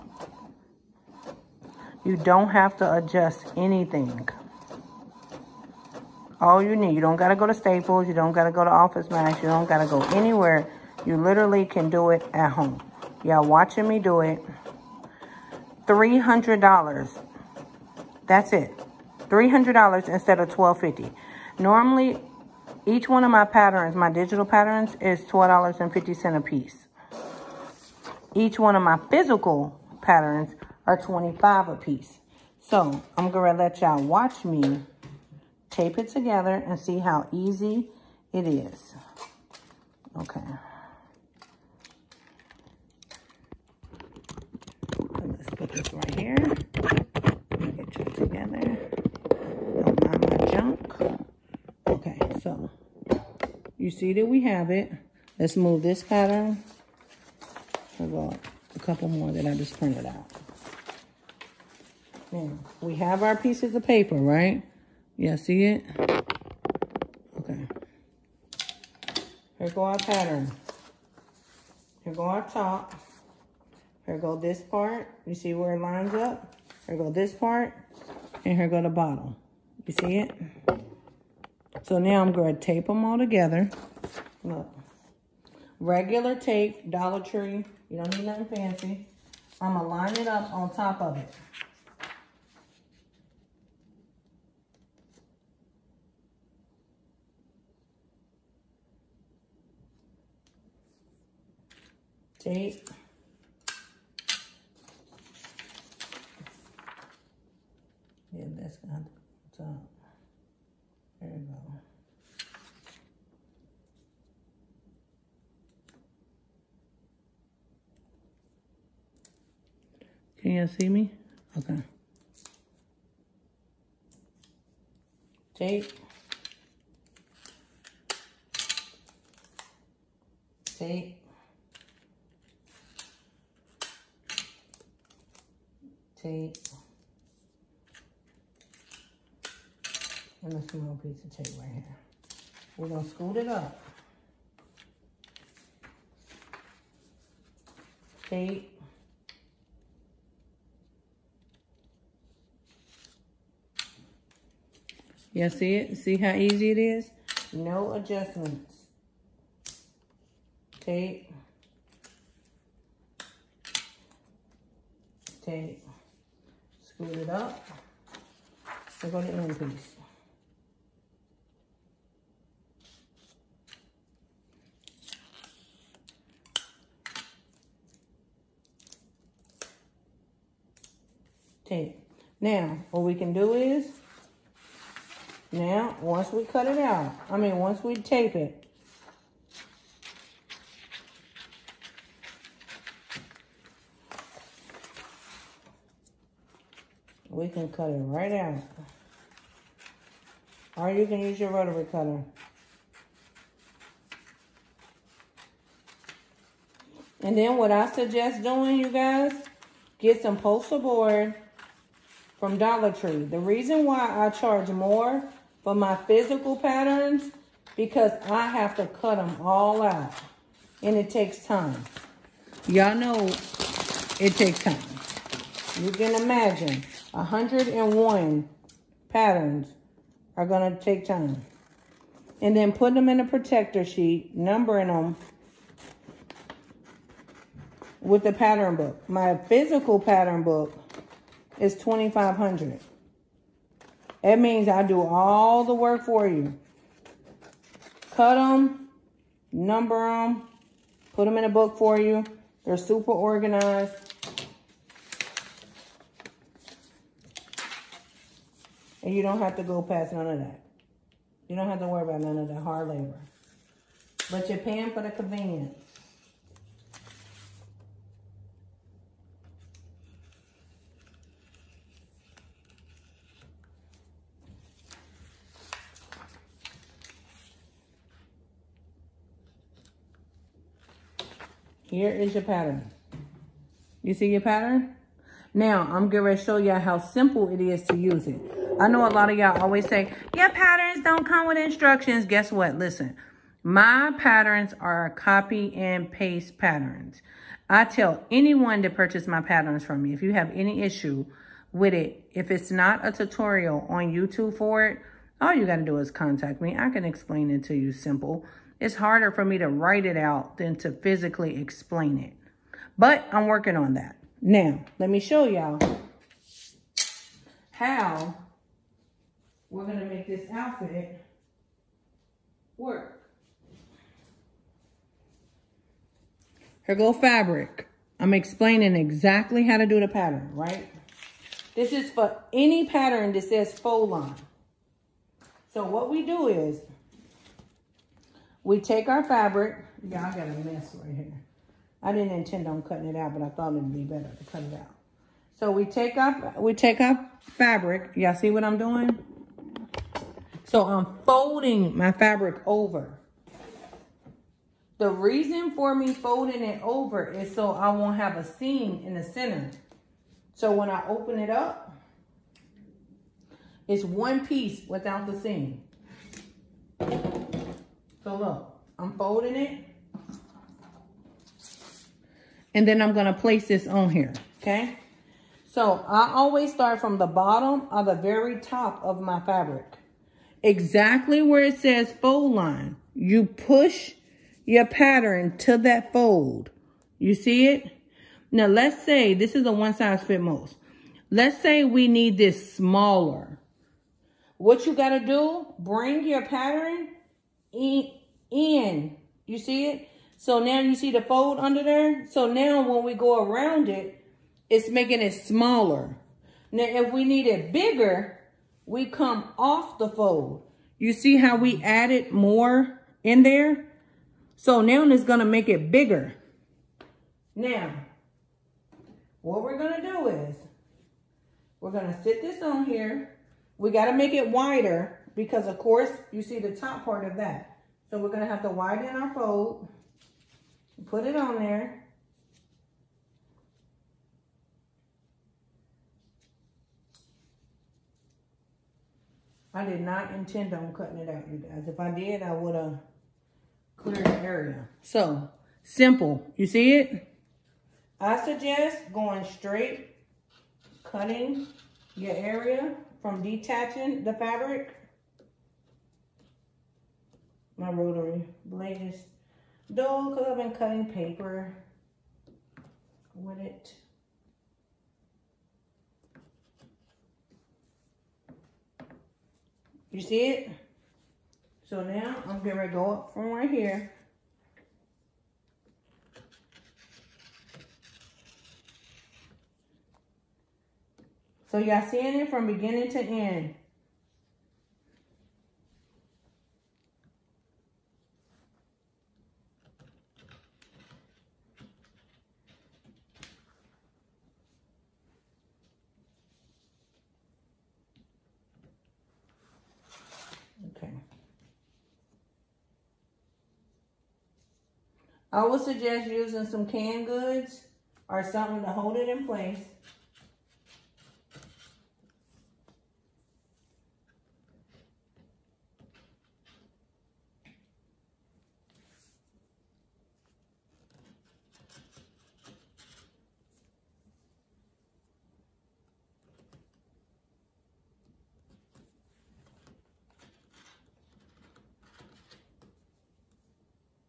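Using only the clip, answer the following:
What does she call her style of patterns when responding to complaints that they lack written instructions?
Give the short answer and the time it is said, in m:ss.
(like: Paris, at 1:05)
copy and paste patterns, at 4:55.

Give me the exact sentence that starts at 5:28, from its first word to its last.
I'm explaining exactly how to do the pattern, right?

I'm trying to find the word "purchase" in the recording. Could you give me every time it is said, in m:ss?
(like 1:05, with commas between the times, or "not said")
4:58.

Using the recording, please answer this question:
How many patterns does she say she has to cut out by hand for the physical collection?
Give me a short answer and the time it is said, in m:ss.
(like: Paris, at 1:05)
101, at 3:47.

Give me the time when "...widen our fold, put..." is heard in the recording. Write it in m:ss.
7:08.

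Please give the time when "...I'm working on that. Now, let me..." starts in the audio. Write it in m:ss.
5:13.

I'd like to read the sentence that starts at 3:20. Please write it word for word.
Or you can use your rotary cutter.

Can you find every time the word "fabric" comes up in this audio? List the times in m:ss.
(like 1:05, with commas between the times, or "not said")
5:27, 5:39, 5:47, 5:52, 6:19, 7:34.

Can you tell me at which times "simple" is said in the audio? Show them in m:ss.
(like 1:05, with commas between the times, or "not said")
4:46, 5:07, 7:25.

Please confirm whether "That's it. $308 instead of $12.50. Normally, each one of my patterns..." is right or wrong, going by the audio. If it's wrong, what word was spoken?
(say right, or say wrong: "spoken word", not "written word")
wrong: "300", not "308".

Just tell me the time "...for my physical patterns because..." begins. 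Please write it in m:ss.
3:35.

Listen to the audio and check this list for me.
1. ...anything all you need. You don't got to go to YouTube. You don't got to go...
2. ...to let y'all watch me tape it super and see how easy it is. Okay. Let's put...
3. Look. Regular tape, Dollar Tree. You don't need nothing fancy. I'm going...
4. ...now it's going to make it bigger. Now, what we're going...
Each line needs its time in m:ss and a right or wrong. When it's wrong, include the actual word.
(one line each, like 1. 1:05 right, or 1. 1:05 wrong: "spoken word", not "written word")
1. 0:03 wrong: "Staples", not "YouTube"
2. 0:33 wrong: "together", not "super"
3. 1:24 right
4. 6:54 right.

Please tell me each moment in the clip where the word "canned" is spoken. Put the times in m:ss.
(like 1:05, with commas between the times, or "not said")
8:26.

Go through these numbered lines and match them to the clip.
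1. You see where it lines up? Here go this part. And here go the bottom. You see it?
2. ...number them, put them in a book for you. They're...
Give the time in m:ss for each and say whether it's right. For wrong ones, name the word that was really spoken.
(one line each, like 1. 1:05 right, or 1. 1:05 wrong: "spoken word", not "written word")
1. 1:15 right
2. 4:09 right.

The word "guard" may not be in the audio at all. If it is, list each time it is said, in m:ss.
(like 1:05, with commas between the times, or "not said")
not said.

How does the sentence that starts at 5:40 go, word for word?
Yeah, I got a mess right here.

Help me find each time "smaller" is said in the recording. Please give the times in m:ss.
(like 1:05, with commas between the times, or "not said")
6:32, 6:45.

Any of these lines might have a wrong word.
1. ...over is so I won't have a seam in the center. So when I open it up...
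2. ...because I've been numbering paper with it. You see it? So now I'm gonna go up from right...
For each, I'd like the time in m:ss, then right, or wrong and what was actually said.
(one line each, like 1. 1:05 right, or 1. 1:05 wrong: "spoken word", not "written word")
1. 5:56 right
2. 7:40 wrong: "cutting", not "numbering".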